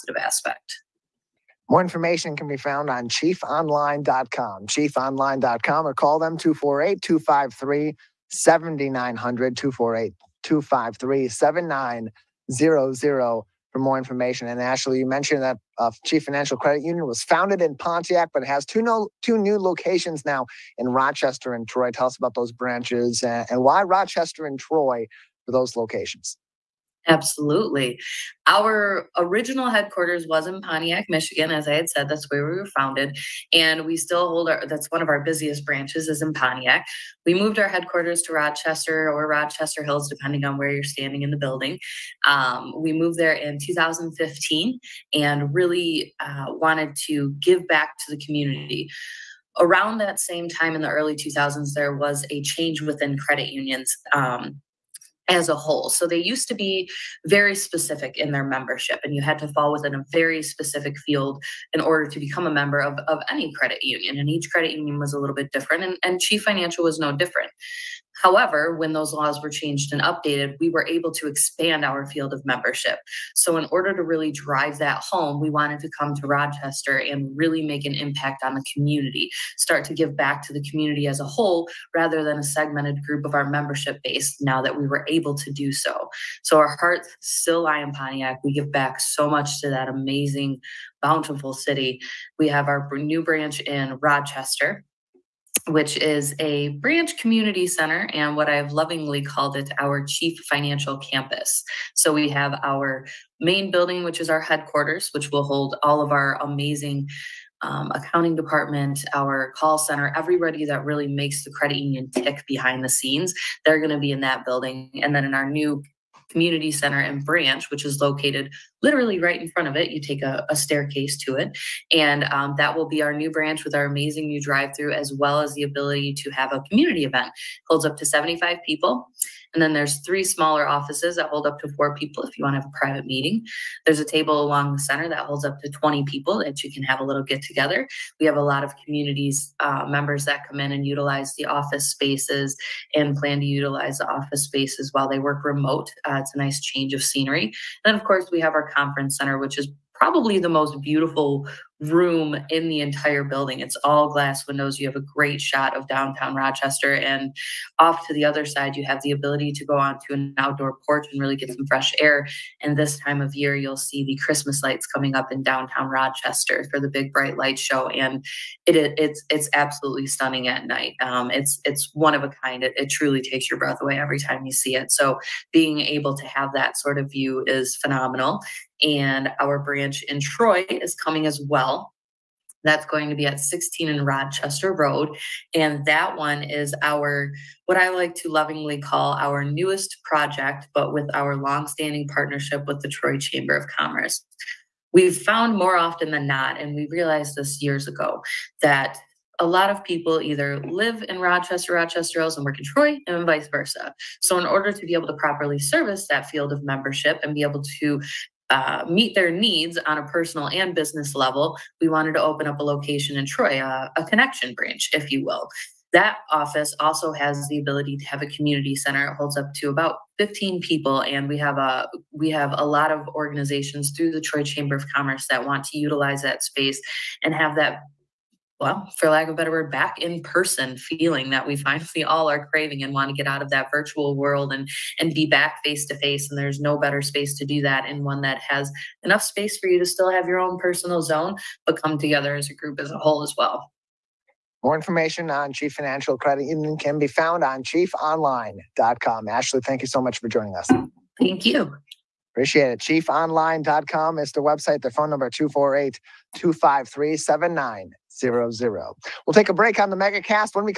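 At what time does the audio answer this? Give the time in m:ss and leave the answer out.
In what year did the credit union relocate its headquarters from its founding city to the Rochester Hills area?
0:43.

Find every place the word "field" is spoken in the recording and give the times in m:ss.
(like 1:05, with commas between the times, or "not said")
1:00, 1:12, 3:26.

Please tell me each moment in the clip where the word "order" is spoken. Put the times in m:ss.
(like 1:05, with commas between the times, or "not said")
1:01, 1:13, 3:24.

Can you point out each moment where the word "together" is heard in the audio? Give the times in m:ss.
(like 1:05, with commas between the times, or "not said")
2:17, 4:01.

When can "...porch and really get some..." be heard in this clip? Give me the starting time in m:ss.
2:40.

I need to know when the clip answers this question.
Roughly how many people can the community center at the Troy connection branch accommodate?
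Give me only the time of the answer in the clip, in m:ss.
3:40.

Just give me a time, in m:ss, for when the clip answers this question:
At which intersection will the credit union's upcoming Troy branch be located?
3:03.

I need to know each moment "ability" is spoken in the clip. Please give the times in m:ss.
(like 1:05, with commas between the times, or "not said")
2:05, 2:39, 3:37.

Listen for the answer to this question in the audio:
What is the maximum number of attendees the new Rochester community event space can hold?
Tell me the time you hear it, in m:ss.
2:08.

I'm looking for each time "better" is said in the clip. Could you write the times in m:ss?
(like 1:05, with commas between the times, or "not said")
3:49, 3:56.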